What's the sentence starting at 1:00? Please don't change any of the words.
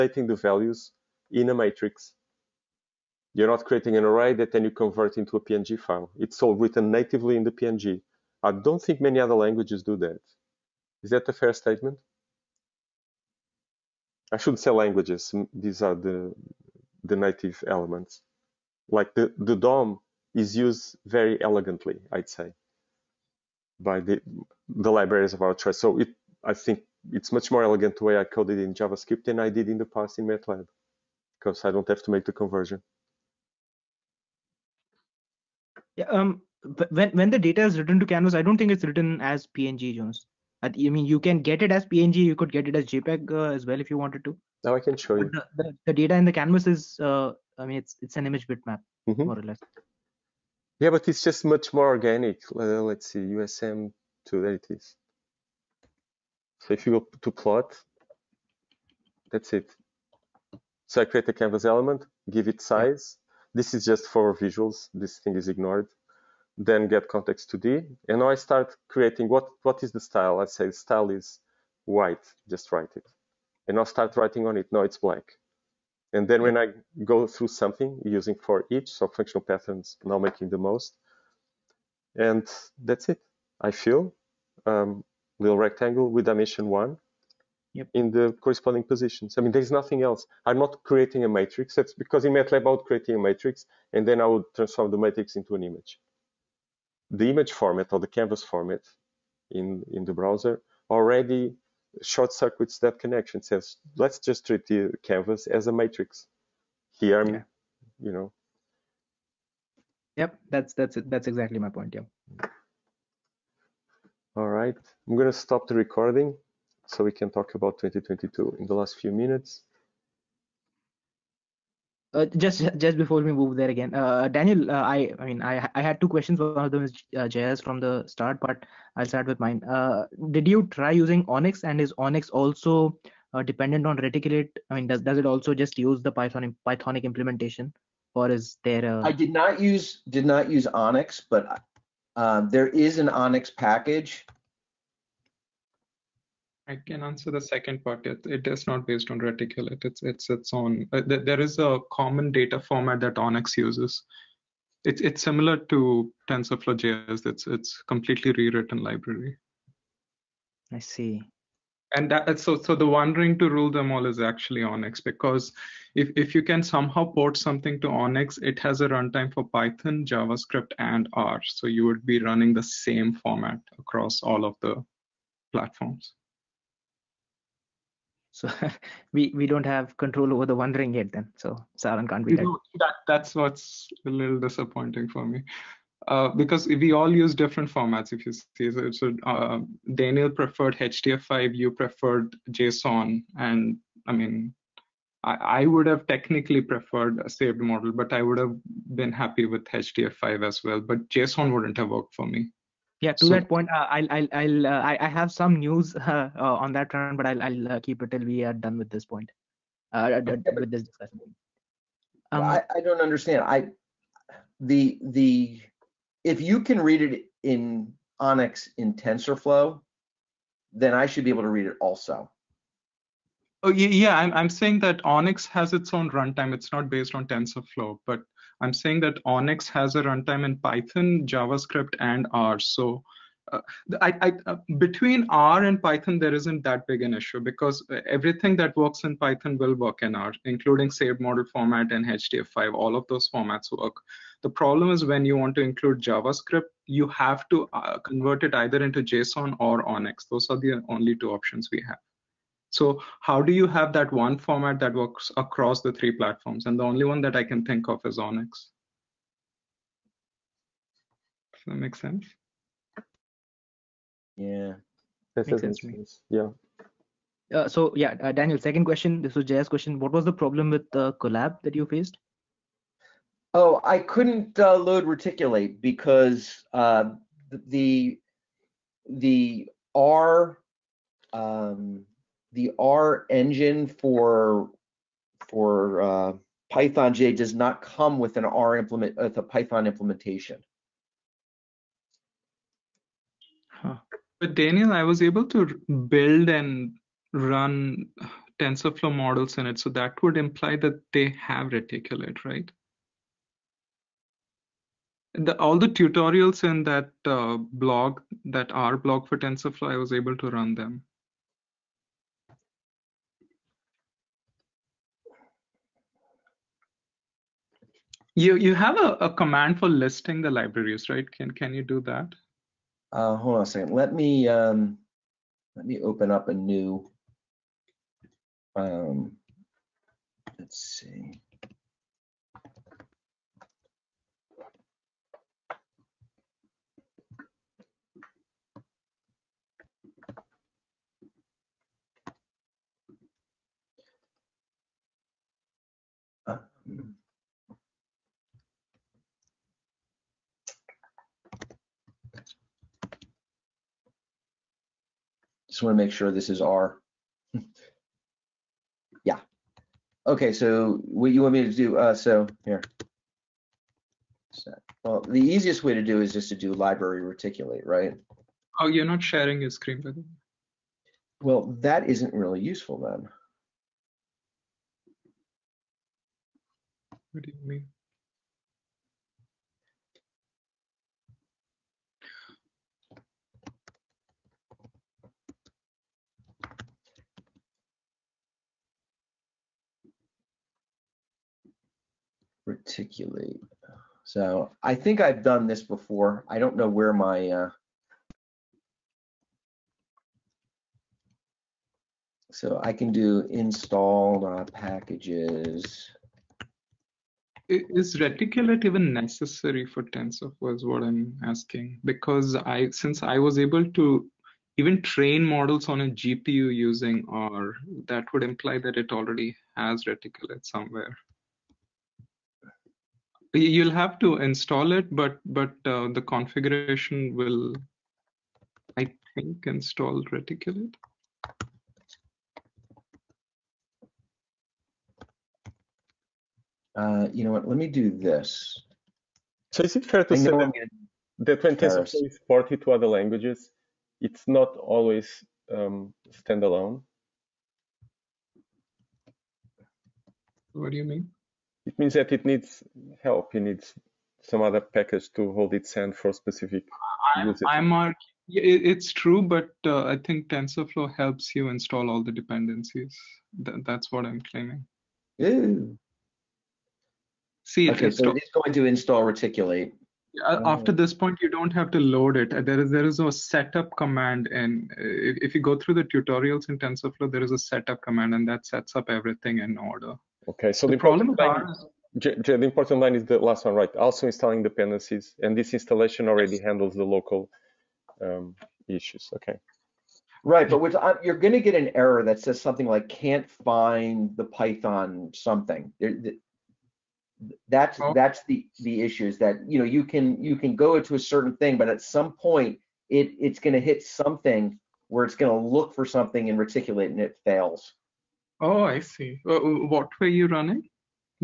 So I create a canvas element, give it size, this is just for visuals.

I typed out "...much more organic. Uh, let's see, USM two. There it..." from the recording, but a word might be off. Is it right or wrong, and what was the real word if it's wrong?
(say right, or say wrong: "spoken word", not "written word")
right.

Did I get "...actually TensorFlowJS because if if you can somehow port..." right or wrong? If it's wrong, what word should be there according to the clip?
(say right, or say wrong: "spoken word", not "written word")
wrong: "ONNX", not "TensorFlowJS".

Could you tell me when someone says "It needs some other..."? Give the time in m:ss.
7:33.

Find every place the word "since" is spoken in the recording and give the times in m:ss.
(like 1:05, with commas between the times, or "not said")
6:52.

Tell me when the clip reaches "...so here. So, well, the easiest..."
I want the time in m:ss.
6:02.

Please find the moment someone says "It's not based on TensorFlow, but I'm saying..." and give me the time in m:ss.
3:46.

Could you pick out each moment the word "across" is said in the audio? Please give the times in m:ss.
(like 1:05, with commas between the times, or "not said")
2:53, 4:15.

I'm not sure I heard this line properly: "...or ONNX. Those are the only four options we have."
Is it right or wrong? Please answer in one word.
wrong.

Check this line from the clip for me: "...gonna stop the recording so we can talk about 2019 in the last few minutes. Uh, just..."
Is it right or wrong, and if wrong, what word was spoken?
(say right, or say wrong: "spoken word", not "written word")
wrong: "2022", not "2019".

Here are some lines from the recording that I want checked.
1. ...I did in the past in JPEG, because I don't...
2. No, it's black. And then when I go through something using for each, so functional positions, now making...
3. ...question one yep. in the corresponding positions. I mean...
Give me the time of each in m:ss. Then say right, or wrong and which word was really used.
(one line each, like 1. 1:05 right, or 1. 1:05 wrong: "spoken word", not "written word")
1. 0:29 wrong: "MATLAB", not "JPEG"
2. 1:14 wrong: "patterns", not "positions"
3. 1:26 wrong: "dimension", not "question".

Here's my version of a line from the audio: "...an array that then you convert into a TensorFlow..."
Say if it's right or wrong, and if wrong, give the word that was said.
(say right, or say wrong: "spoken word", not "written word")
wrong: "PNG", not "TensorFlow".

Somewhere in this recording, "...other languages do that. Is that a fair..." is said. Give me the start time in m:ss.
0:09.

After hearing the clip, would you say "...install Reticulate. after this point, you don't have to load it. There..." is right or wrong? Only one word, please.
right.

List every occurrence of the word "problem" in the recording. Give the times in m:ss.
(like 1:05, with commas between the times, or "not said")
4:04, 4:30, 8:00.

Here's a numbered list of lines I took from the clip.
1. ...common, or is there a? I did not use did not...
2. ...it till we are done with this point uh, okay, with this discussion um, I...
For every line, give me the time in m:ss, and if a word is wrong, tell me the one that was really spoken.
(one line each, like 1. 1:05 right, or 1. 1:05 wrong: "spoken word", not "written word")
1. 2:17 wrong: "implementation", not "common"
2. 3:28 right.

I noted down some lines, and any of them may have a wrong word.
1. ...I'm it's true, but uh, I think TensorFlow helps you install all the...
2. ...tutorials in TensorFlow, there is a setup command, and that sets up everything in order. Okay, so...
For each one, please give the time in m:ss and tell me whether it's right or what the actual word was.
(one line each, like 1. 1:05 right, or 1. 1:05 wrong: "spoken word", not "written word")
1. 7:37 right
2. 7:56 right.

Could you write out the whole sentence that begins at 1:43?
Says, let's just treat the canvas as a matrix.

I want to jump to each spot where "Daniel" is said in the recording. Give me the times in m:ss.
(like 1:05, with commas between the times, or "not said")
2:04, 3:09, 4:28, 4:54.